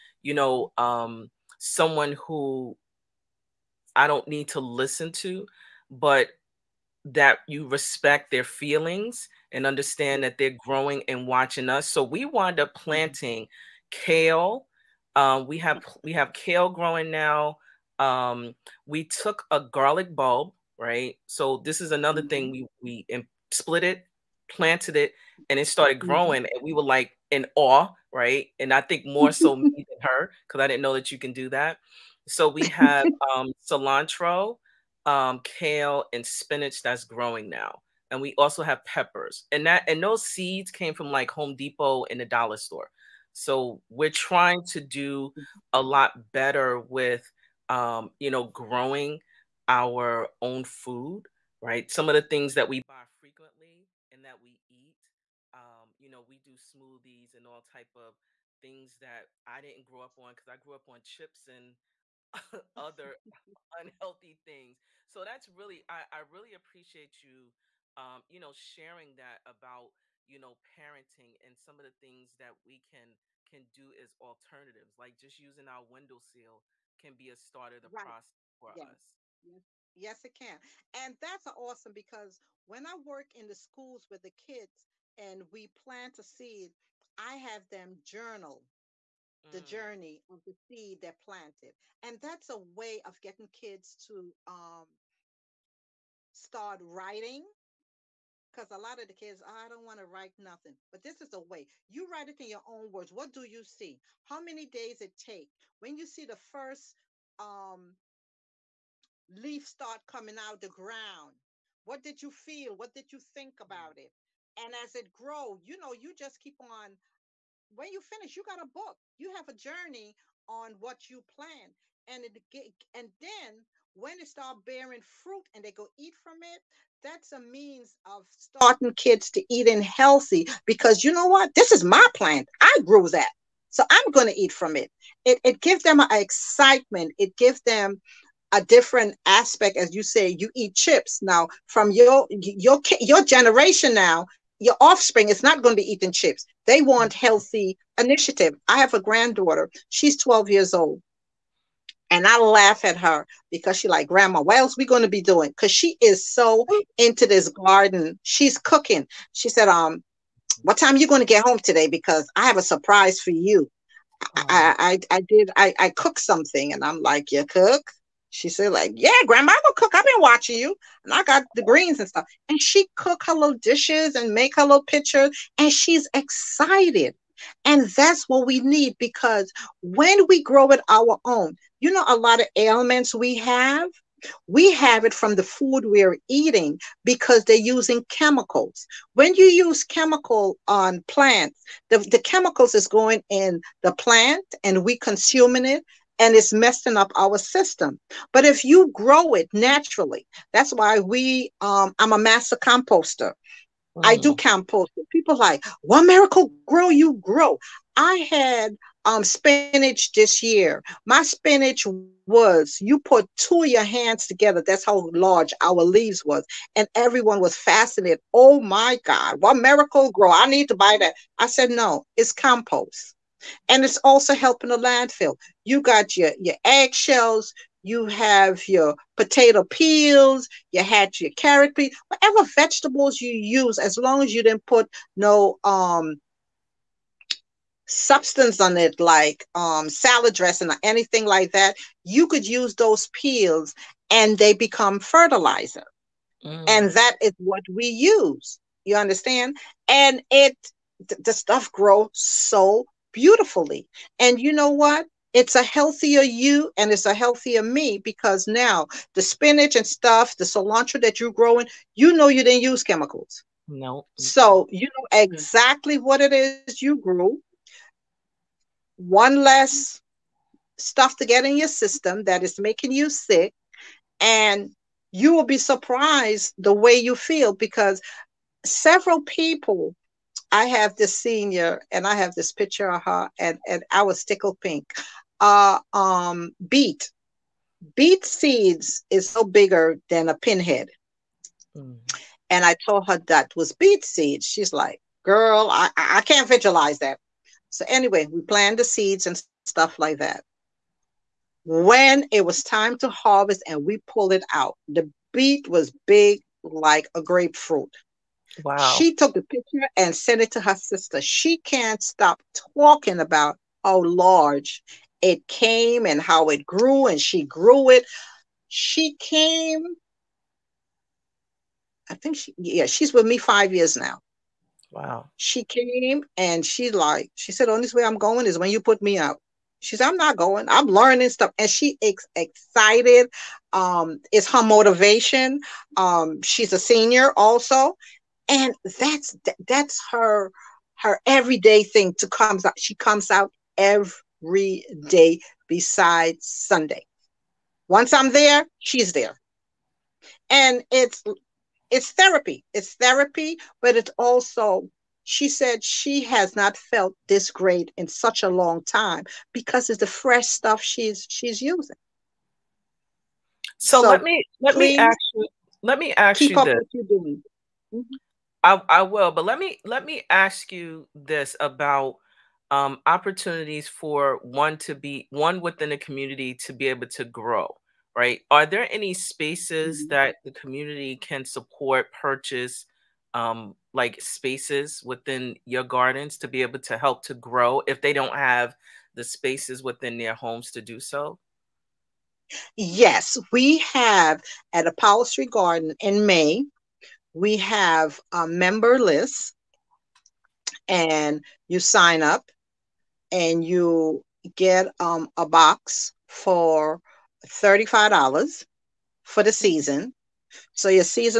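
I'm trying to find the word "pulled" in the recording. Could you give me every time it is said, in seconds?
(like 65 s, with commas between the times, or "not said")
304 s.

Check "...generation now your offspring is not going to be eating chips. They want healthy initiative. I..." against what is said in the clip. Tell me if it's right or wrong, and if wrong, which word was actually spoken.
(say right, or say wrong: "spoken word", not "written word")
right.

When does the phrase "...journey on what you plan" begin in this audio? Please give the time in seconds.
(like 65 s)
119 s.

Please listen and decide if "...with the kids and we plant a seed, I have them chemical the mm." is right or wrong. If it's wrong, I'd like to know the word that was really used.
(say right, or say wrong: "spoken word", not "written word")
wrong: "journal", not "chemical".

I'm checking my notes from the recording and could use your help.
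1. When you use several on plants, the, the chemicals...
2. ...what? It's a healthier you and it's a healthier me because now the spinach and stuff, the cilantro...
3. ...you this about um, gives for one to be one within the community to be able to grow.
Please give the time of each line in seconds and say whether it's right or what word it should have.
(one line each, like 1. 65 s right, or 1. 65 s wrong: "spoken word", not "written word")
1. 189 s wrong: "chemical", not "several"
2. 254 s right
3. 370 s wrong: "opportunities", not "gives".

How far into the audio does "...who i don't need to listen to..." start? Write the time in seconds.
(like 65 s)
2 s.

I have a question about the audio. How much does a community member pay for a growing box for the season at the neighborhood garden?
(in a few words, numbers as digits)
$35.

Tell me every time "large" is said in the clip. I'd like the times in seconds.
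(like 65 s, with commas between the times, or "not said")
215 s, 314 s.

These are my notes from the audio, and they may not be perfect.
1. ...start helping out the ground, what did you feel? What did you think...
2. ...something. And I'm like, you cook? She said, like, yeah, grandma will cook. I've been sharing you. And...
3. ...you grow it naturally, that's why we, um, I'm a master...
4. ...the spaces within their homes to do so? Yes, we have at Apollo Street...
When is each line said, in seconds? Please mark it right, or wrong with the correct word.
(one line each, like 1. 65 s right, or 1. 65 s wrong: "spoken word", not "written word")
1. 109 s wrong: "coming", not "helping"
2. 166 s wrong: "watching", not "sharing"
3. 198 s right
4. 389 s right.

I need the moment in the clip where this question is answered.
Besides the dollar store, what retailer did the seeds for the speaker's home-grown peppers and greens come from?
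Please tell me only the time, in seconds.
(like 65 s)
41 s.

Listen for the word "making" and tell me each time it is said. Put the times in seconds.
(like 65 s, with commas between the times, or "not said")
272 s.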